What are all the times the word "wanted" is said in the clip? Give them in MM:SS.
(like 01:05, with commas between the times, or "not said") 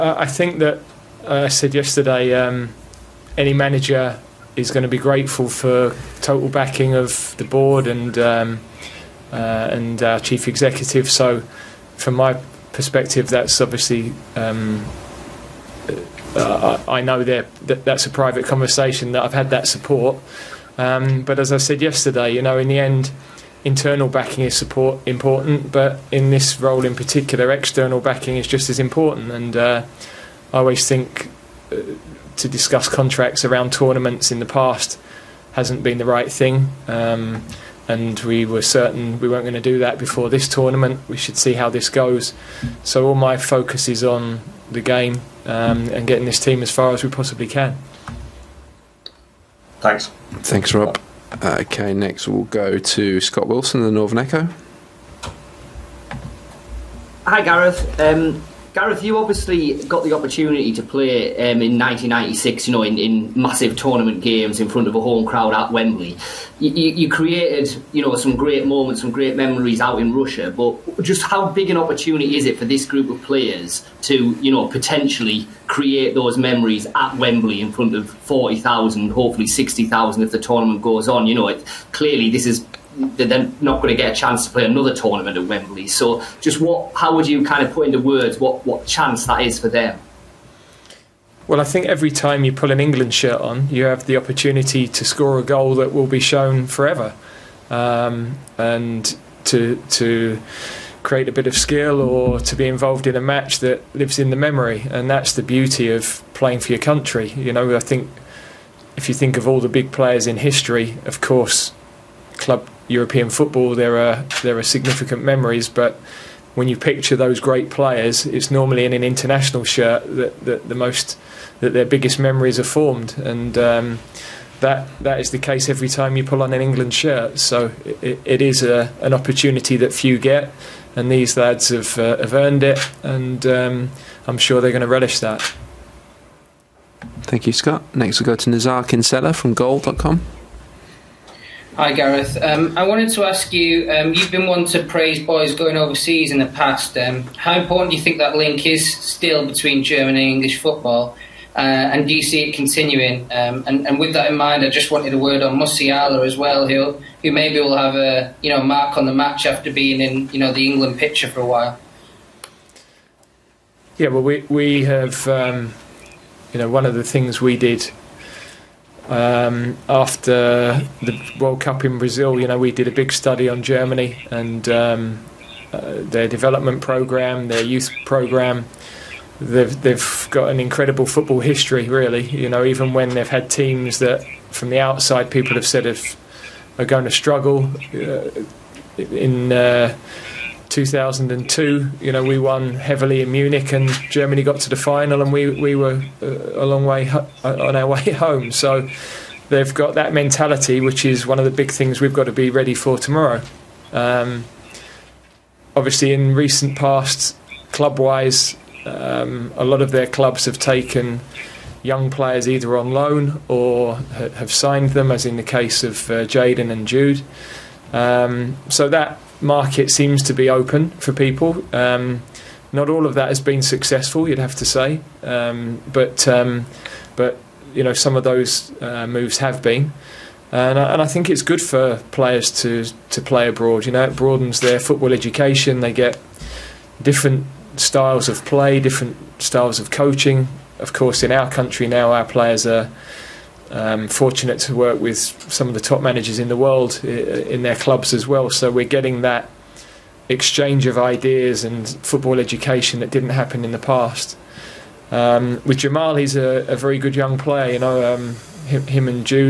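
02:22, 02:34.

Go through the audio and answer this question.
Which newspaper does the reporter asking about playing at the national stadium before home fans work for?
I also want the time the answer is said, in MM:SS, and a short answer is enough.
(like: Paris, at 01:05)
The Northern Echo, at 00:53.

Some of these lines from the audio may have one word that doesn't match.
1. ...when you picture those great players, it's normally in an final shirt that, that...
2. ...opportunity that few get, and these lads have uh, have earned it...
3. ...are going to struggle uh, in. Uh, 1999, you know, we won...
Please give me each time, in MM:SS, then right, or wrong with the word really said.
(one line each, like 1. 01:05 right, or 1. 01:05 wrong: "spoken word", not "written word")
1. 01:56 wrong: "international", not "final"
2. 02:09 right
3. 03:06 wrong: "2002", not "1999".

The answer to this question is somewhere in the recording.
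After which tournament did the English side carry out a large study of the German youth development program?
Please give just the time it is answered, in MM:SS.
02:51.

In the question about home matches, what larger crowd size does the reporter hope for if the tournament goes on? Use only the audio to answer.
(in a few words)
60,000.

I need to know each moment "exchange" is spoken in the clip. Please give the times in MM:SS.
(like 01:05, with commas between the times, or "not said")
04:10.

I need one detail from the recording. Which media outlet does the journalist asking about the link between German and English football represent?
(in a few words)
Goal.com.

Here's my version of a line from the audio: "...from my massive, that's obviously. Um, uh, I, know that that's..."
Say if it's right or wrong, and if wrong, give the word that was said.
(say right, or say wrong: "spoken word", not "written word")
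wrong: "perspective", not "massive".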